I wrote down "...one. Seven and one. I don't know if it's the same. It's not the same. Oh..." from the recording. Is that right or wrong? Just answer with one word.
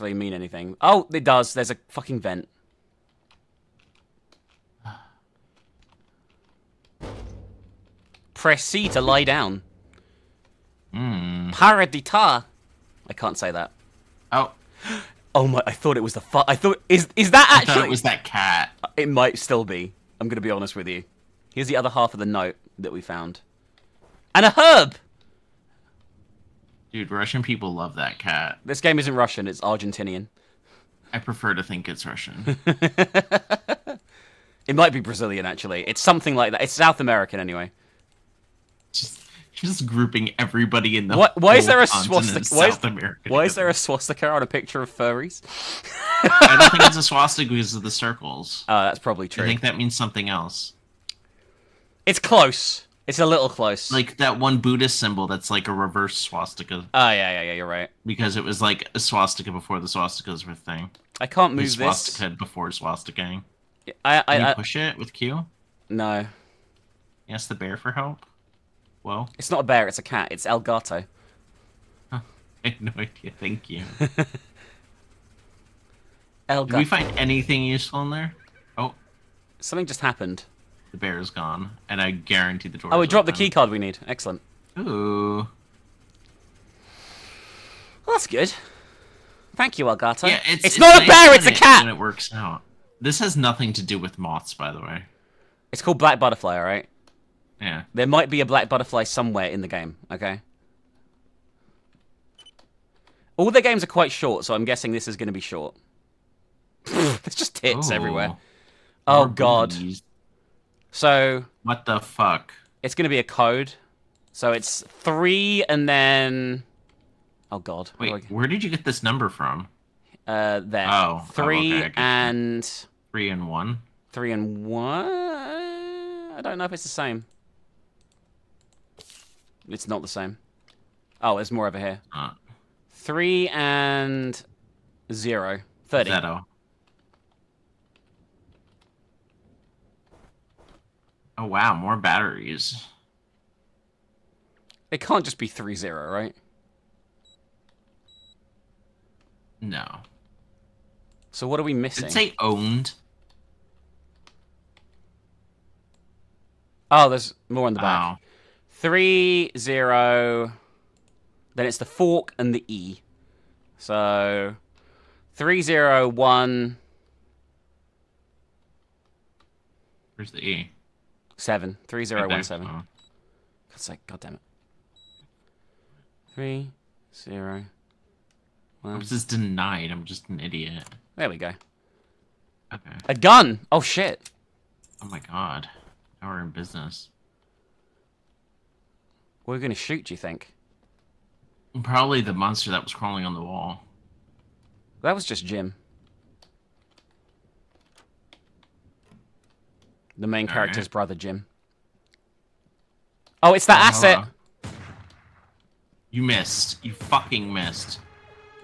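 wrong.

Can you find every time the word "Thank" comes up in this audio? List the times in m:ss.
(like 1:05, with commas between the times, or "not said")
1:13, 1:29.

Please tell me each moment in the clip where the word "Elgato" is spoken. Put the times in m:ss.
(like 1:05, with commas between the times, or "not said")
1:10, 1:16, 1:29.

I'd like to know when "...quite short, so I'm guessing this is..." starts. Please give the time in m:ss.
1:43.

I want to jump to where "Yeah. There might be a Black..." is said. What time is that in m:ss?
1:37.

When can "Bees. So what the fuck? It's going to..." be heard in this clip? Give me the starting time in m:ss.
1:49.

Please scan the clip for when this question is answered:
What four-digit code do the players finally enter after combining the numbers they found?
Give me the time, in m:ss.
2:51.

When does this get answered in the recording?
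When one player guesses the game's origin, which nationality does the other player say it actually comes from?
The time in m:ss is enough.
0:29.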